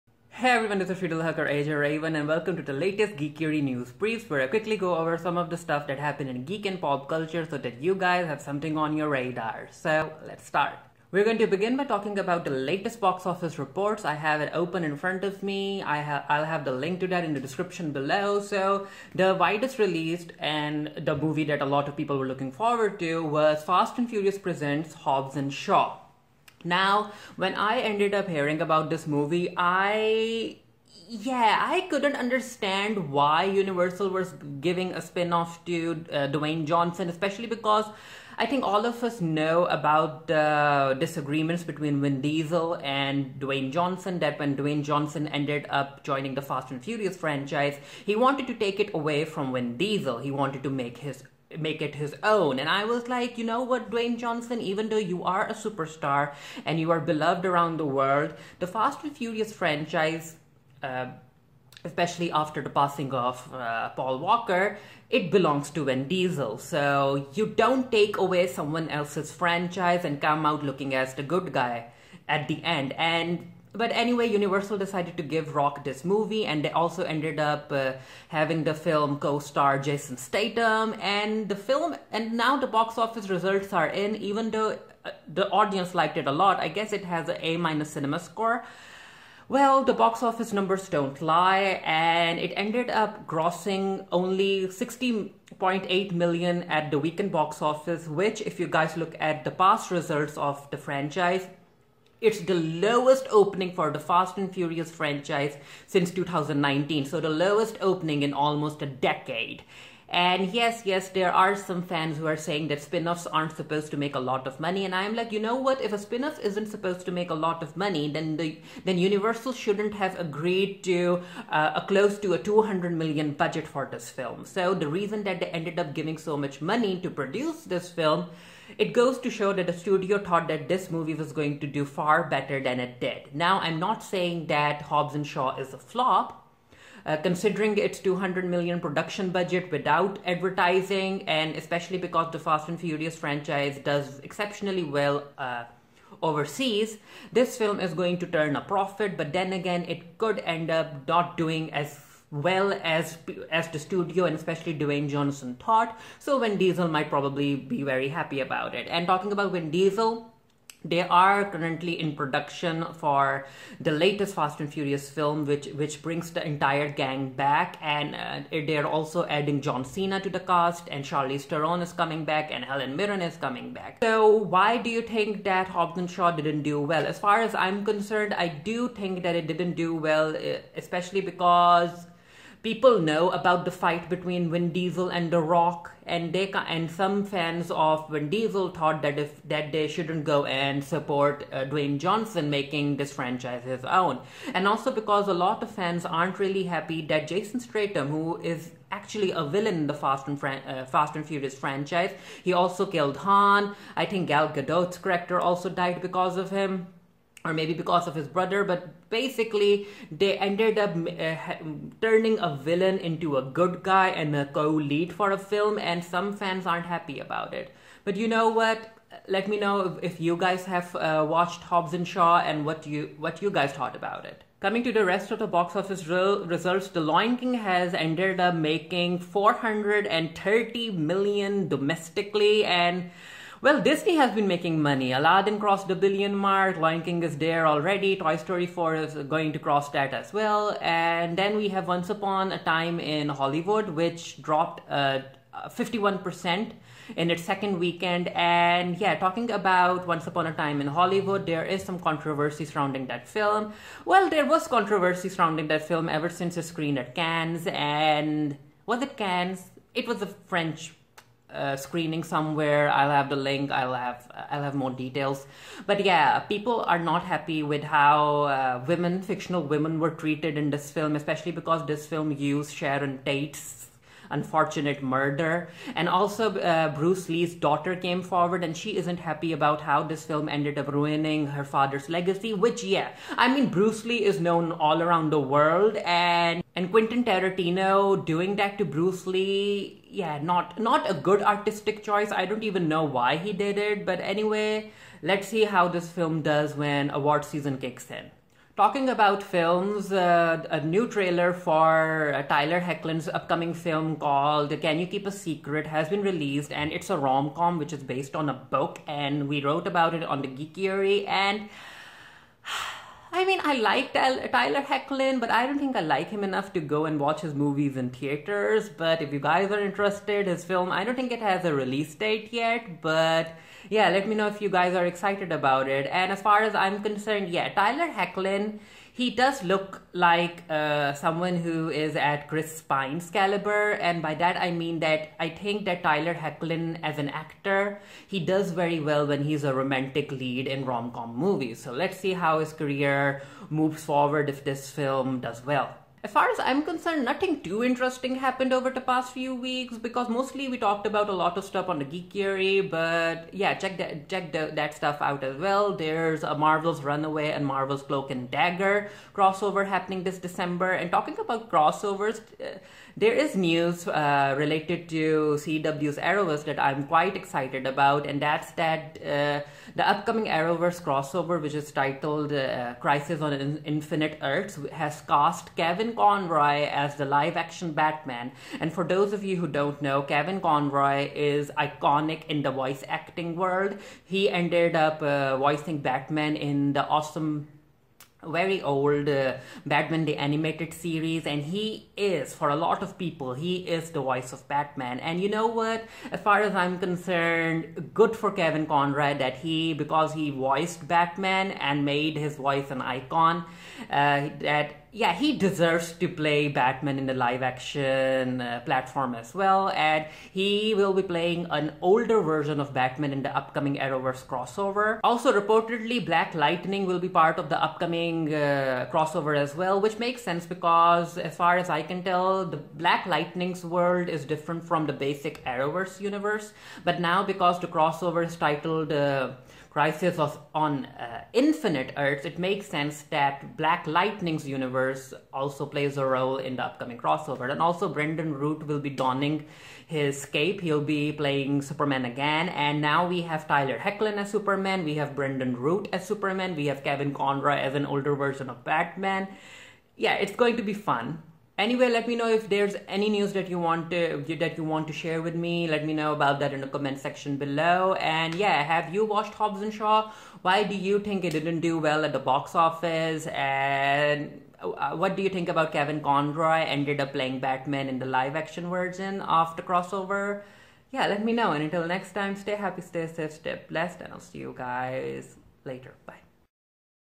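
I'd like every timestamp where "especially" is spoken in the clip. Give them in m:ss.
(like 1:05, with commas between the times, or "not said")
0:37, 1:01, 2:21, 2:34, 3:00, 4:31.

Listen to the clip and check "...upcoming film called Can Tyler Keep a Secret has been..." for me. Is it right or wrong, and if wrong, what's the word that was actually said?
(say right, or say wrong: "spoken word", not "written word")
wrong: "You", not "Tyler".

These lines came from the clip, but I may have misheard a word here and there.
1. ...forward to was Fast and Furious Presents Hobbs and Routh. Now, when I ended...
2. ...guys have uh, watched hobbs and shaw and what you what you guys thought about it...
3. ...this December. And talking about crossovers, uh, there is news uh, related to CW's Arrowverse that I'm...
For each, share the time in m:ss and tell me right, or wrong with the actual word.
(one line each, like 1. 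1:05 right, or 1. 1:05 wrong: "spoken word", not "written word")
1. 0:22 wrong: "Shaw", not "Routh"
2. 3:40 right
3. 6:00 right.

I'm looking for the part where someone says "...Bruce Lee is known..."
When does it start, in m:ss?
4:43.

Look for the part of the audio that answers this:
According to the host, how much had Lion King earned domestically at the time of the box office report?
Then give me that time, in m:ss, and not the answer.
3:49.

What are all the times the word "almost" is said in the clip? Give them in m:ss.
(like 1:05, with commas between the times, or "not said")
1:48.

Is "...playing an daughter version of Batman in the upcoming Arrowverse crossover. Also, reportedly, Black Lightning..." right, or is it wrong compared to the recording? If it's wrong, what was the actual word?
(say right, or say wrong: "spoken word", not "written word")
wrong: "older", not "daughter".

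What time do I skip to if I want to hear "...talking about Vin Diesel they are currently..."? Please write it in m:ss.
2:39.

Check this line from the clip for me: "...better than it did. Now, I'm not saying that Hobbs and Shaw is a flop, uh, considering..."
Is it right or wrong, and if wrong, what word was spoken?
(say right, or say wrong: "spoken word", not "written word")
right.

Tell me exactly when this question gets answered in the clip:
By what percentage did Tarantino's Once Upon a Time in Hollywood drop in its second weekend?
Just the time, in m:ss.
4:05.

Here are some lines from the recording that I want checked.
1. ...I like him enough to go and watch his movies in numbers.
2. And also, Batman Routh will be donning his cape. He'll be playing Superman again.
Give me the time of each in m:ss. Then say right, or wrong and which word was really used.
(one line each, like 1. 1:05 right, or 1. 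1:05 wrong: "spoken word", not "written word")
1. 5:15 wrong: "theaters", not "numbers"
2. 7:17 wrong: "Brandon", not "Batman".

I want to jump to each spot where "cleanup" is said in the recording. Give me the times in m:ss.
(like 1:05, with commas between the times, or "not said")
not said.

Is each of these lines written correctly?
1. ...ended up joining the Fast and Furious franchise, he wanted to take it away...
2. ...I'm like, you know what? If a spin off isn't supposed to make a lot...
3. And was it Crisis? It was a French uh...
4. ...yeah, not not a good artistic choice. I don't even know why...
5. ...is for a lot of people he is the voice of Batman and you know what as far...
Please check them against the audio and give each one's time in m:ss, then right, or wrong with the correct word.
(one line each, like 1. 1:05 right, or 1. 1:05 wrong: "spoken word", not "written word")
1. 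0:45 right
2. 1:54 right
3. 4:17 wrong: "Cannes", not "Crisis"
4. 4:50 right
5. 6:32 right.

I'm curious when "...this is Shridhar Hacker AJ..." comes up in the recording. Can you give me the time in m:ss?
0:00.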